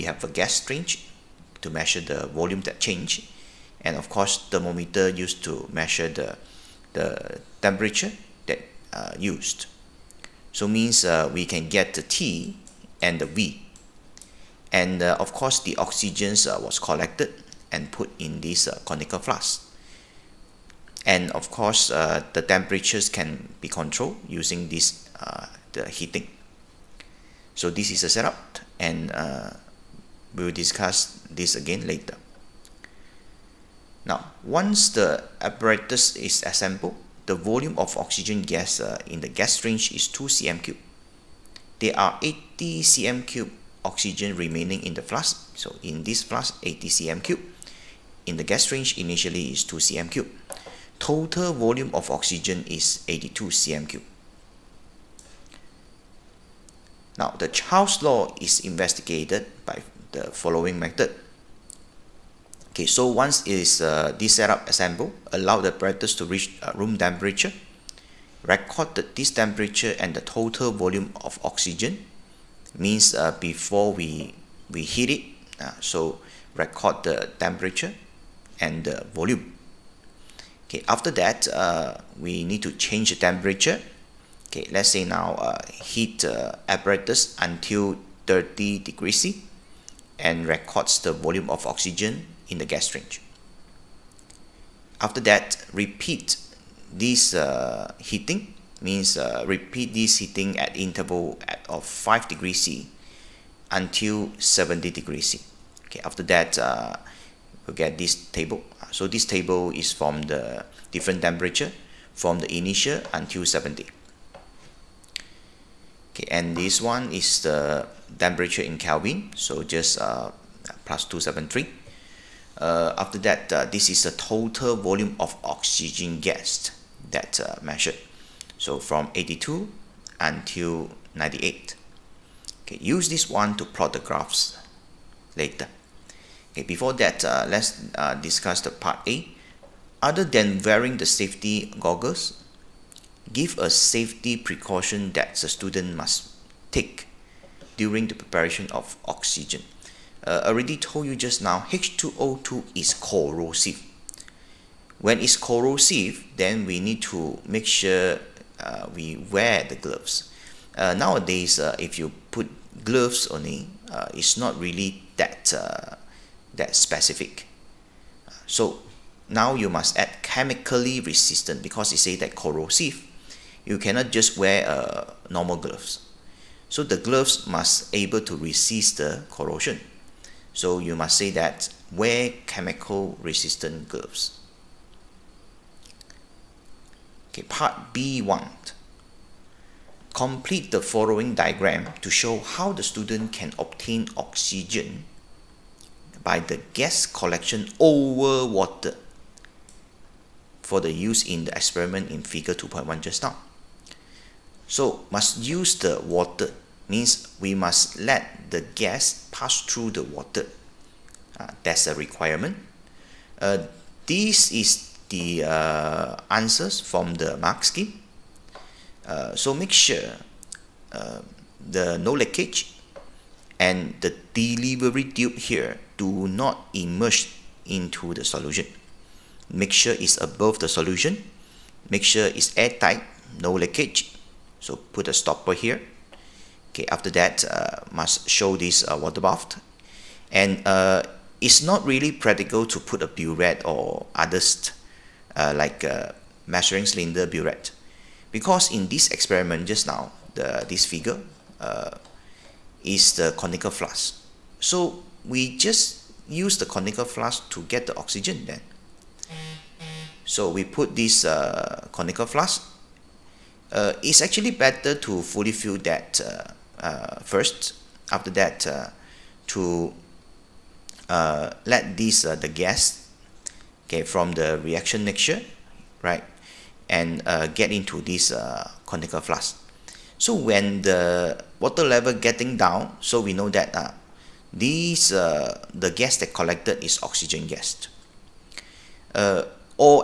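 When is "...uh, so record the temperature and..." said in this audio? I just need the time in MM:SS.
01:15.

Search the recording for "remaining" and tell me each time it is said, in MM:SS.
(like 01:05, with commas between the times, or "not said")
00:44.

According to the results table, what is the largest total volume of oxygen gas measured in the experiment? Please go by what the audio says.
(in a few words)
98.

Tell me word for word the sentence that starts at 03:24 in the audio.
So must use the water means we must let the gas pass through the water.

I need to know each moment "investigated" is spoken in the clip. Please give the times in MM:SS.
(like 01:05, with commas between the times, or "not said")
00:58.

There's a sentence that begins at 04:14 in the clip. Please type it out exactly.
So we just use the conical flask to get the oxygen then.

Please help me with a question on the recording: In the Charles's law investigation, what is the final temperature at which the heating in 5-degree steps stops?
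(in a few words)
70 degrees C.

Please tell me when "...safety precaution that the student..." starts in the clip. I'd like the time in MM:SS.
02:23.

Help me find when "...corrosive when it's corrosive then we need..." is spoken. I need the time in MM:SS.
02:32.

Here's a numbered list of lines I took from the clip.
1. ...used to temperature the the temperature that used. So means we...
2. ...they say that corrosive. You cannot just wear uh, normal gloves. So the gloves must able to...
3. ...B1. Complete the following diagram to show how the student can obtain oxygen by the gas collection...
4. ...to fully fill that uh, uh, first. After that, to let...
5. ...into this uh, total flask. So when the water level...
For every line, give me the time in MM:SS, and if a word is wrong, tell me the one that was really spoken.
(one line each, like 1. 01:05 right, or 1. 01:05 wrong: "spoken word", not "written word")
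1. 00:05 wrong: "measure", not "temperature"
2. 02:51 right
3. 03:07 right
4. 04:24 right
5. 04:37 wrong: "conical", not "total".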